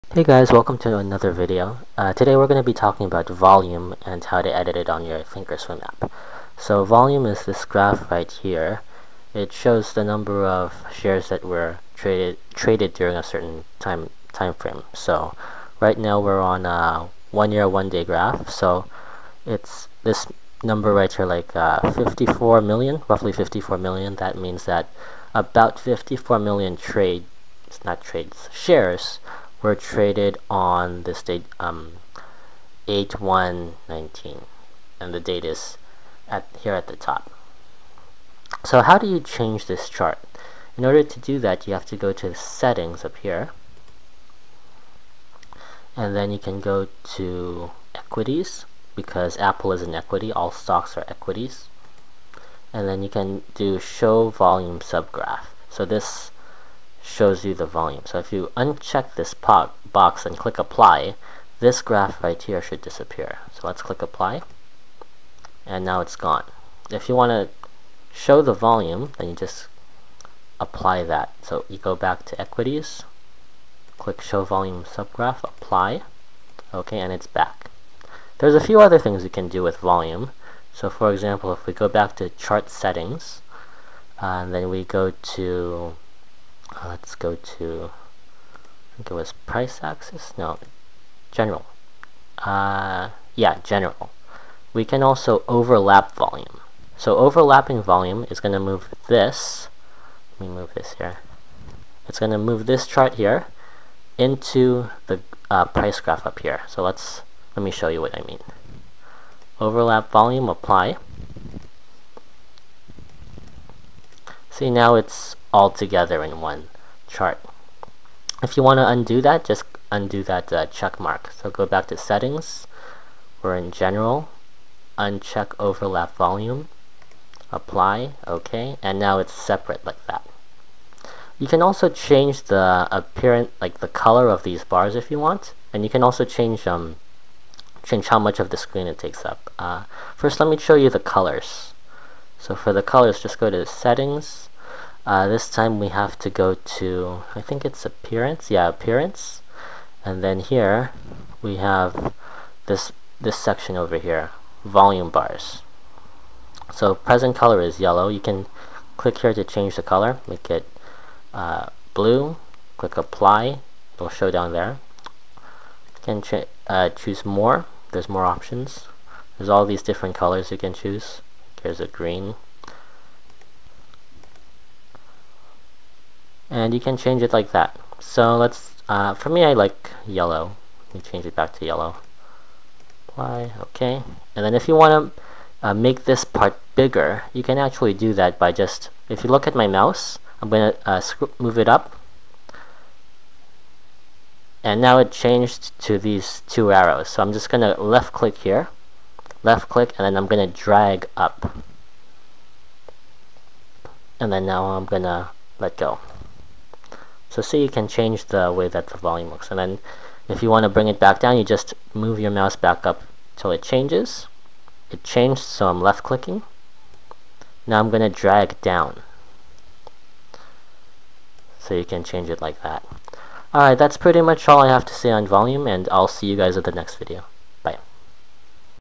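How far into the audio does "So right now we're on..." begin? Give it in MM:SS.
00:14.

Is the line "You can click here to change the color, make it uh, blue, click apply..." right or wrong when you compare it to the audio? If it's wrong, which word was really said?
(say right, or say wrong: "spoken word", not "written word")
right.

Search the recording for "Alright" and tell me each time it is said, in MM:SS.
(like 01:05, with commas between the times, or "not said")
03:43.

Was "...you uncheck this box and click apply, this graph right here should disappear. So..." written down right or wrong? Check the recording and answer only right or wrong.
right.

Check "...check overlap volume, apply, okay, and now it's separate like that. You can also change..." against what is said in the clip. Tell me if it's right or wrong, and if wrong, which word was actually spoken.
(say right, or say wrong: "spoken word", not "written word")
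wrong: "uncheck", not "check".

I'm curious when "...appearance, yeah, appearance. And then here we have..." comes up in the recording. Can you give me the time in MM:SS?
02:27.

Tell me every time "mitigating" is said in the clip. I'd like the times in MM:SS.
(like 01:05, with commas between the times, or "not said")
not said.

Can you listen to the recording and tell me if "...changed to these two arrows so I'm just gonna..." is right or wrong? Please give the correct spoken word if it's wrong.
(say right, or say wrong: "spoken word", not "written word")
right.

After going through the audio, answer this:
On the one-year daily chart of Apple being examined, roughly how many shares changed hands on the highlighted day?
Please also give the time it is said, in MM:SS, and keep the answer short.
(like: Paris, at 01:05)
54 million, at 00:23.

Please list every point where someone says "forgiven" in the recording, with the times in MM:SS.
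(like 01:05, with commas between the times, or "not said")
not said.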